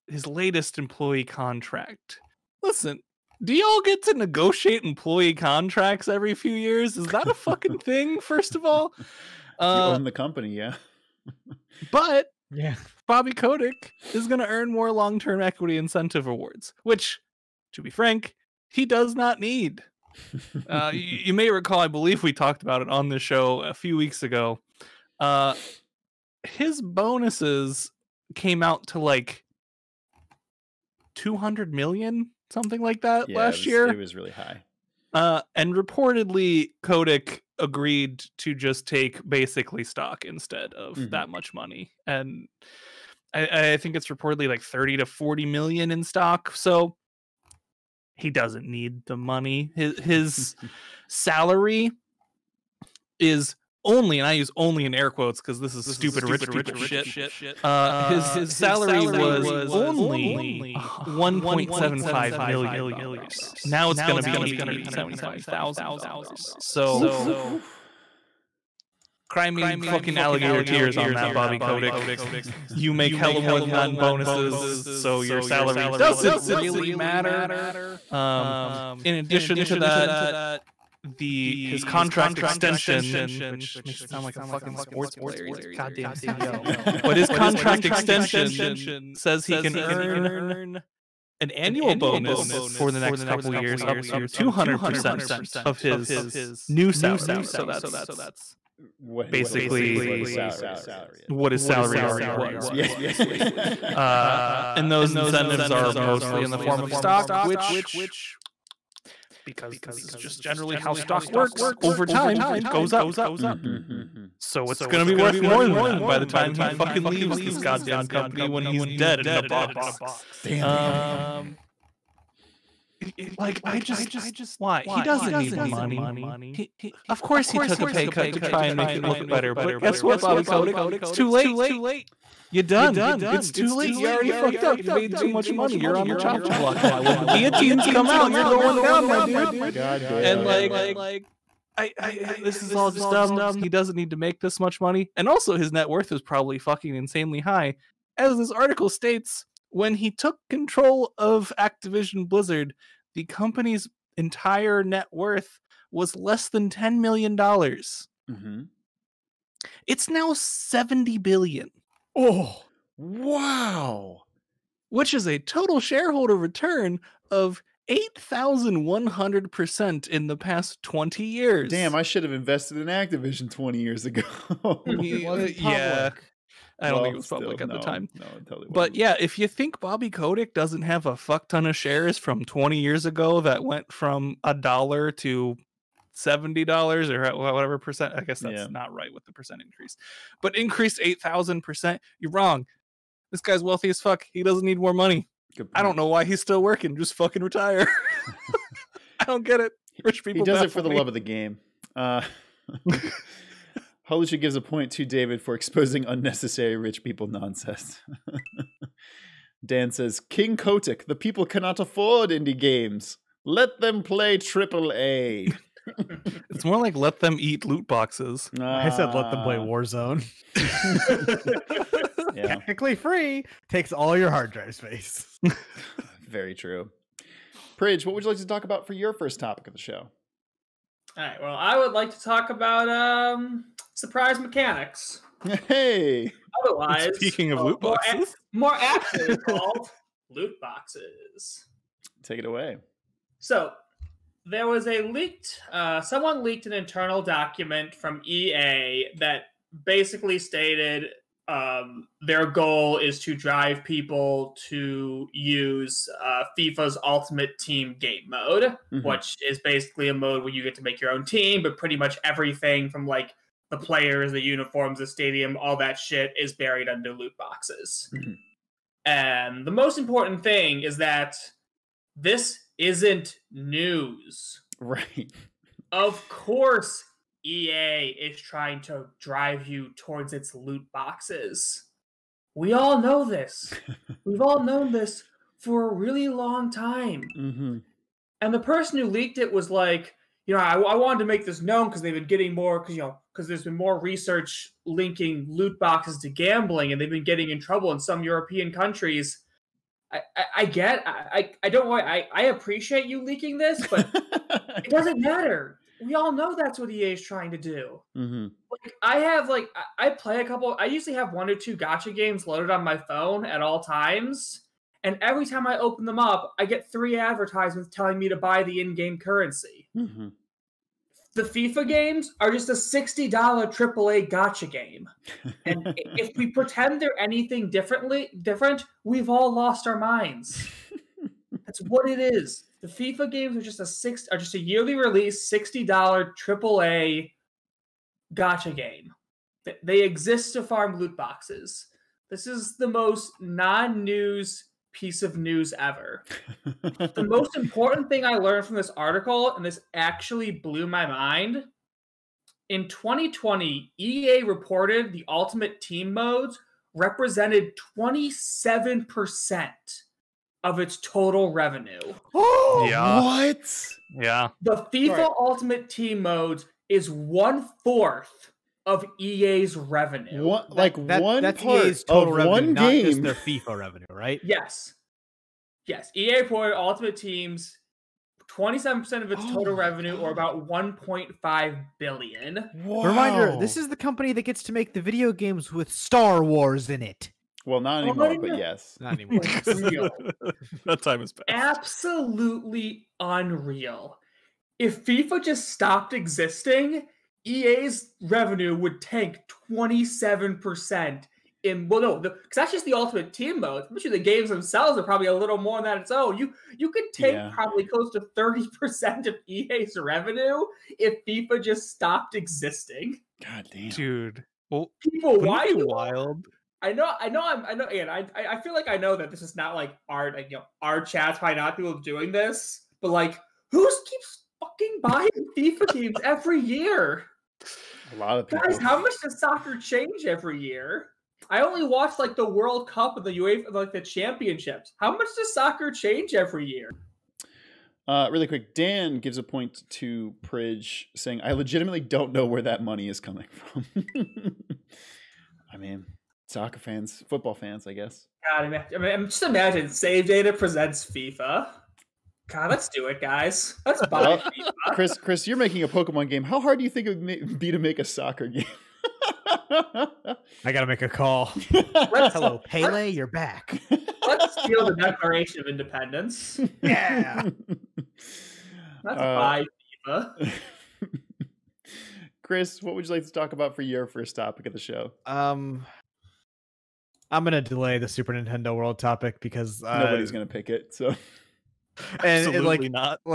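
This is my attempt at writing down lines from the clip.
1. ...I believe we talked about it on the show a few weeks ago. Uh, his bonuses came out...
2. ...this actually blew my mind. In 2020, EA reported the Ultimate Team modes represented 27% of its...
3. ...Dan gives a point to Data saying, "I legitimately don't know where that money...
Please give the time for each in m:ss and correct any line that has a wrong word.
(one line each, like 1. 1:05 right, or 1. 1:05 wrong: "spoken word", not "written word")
1. 0:21 right
2. 5:49 right
3. 7:18 wrong: "Pridge", not "Data".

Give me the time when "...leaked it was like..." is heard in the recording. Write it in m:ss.
4:49.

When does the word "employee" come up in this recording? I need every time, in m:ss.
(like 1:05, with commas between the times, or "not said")
0:00, 0:04.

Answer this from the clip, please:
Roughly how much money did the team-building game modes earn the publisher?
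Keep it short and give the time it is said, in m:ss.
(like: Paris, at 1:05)
$1.5 billion, at 6:20.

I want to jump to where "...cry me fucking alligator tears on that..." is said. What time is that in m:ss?
1:09.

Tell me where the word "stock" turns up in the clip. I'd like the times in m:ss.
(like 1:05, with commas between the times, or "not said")
0:39, 0:46, 1:46, 1:50.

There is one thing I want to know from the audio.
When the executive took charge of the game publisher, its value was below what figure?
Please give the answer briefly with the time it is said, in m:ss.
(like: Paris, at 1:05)
$10 million, at 2:36.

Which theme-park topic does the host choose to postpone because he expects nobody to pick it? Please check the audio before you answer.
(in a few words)
Super Nintendo World.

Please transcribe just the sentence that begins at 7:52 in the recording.
Chris, what would you like to talk about for your first topic of the show?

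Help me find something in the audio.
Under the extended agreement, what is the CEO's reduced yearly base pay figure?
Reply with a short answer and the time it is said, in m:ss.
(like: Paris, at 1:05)
$875,000, at 1:04.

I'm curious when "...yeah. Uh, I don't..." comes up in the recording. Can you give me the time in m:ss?
2:55.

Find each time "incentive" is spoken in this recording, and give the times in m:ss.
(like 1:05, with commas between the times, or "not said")
0:15, 1:45.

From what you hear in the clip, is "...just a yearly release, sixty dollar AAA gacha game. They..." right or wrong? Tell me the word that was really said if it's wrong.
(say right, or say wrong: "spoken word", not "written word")
right.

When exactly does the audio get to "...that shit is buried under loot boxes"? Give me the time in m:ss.
4:25.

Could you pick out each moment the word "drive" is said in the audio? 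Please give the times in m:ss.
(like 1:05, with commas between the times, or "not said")
3:44, 4:13, 4:39.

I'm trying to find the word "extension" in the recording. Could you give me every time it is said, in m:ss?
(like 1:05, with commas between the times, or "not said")
1:22, 1:27.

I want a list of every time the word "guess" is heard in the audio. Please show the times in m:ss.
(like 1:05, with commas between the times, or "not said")
2:09, 3:08, 7:27.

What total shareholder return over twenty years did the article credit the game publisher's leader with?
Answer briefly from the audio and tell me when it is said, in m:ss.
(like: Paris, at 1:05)
8,100%, at 2:47.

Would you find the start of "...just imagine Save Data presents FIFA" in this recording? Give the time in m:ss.
7:29.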